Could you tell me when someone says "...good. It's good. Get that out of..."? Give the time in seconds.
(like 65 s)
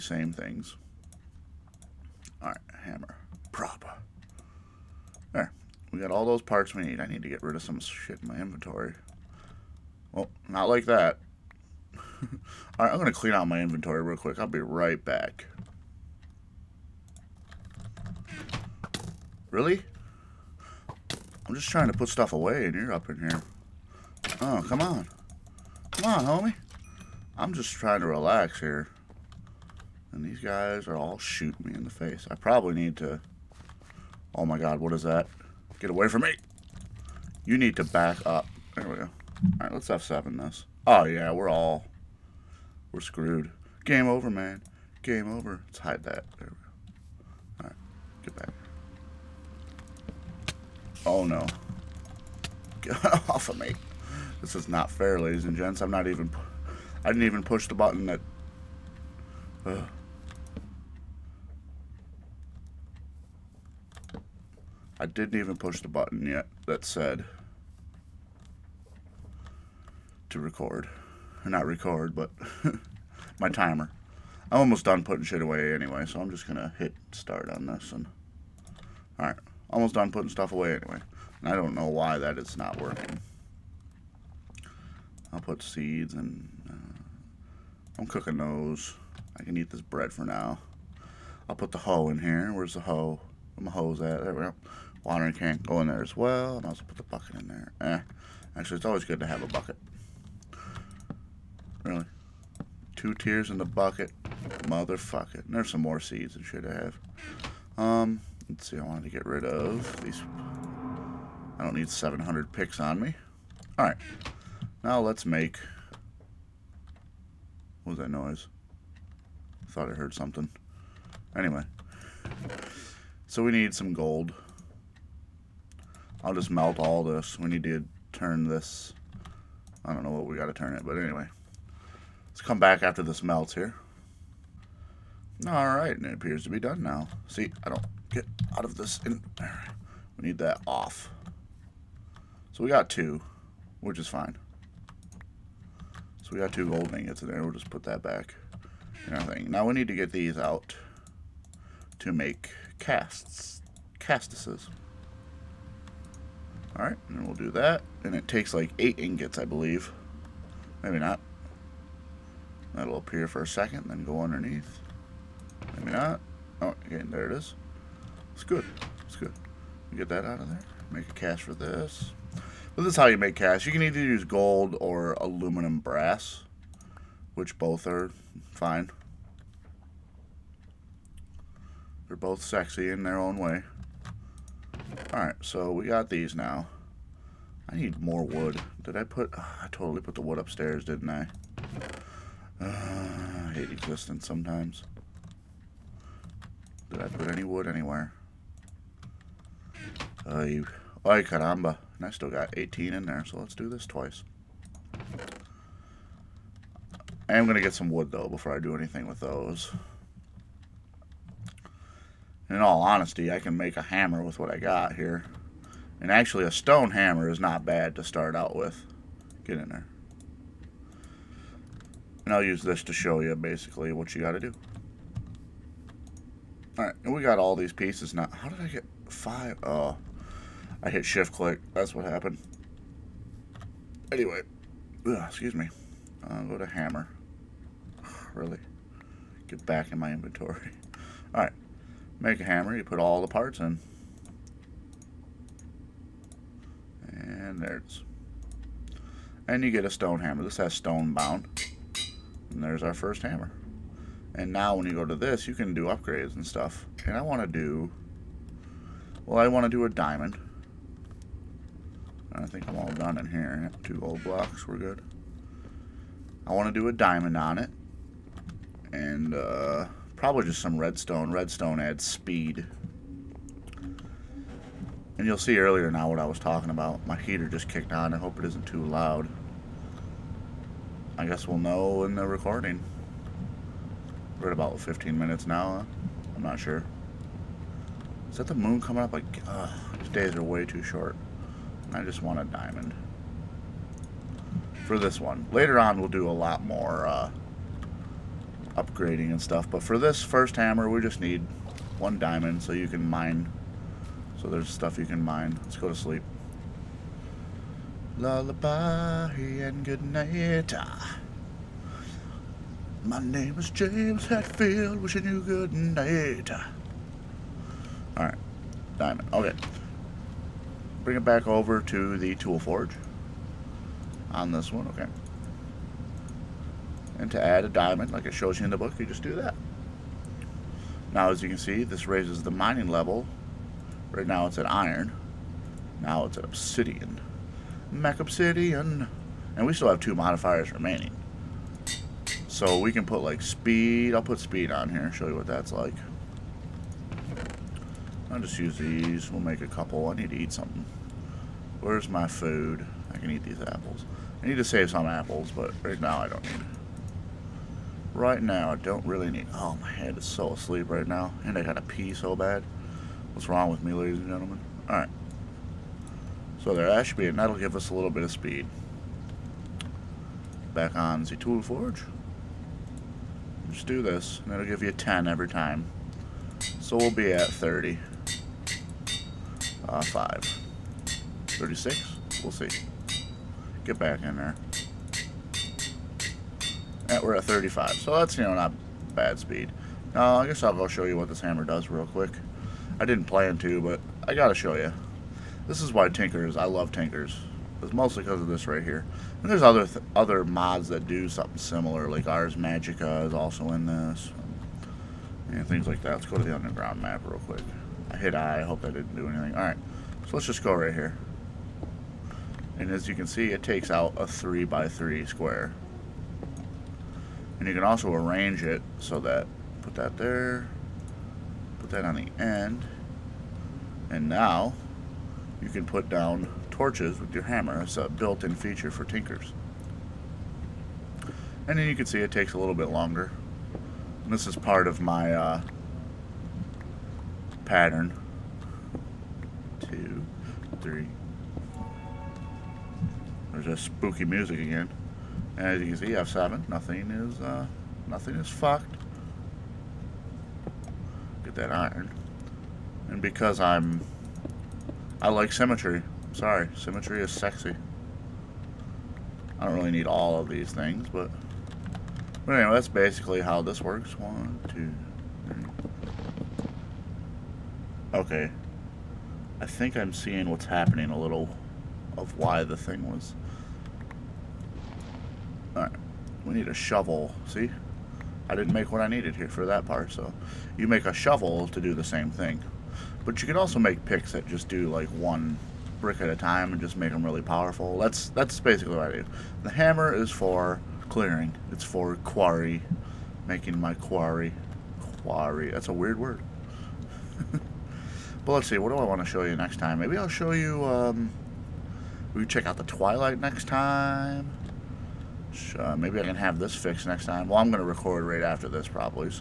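168 s.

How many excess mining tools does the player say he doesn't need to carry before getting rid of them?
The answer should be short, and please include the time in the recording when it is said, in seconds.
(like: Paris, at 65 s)
700, at 111 s.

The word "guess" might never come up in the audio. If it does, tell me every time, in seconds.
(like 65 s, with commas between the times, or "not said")
281 s, 390 s.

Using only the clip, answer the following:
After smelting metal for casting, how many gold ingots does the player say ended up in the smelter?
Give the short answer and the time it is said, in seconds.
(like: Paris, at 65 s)
2, at 146 s.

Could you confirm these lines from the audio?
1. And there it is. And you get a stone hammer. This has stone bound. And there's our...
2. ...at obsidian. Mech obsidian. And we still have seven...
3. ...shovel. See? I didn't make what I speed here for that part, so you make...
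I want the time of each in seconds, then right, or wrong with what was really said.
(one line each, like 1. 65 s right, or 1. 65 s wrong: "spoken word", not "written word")
1. 247 s right
2. 336 s wrong: "two", not "seven"
3. 476 s wrong: "needed", not "speed".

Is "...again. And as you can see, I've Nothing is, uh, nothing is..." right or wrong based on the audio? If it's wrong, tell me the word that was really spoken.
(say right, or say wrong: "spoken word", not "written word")
right.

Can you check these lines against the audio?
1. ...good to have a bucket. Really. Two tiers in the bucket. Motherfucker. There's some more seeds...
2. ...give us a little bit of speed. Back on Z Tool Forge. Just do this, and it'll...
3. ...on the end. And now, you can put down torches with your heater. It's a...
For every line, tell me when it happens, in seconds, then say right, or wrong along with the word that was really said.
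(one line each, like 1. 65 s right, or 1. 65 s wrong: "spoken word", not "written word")
1. 99 s right
2. 367 s right
3. 422 s wrong: "hammer", not "heater".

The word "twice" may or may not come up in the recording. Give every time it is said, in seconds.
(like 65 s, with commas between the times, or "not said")
203 s.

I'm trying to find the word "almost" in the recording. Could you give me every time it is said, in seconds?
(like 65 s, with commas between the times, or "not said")
74 s, 79 s.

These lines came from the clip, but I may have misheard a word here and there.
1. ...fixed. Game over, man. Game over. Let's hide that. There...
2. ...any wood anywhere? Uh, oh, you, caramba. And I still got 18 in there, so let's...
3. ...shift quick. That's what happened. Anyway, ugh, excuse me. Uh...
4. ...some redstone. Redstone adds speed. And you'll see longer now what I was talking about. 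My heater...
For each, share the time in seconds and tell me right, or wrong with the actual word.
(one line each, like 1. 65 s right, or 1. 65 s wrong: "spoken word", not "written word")
1. 42 s wrong: "screwed", not "fixed"
2. 197 s right
3. 231 s wrong: "click", not "quick"
4. 270 s wrong: "earlier", not "longer".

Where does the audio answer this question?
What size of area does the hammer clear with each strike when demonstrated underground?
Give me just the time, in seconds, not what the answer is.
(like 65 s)
414 s.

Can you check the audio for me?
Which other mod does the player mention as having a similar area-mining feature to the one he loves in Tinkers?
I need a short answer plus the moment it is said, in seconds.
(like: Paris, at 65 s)
Ars Magica, at 402 s.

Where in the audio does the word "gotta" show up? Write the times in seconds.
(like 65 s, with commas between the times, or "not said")
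361 s, 394 s.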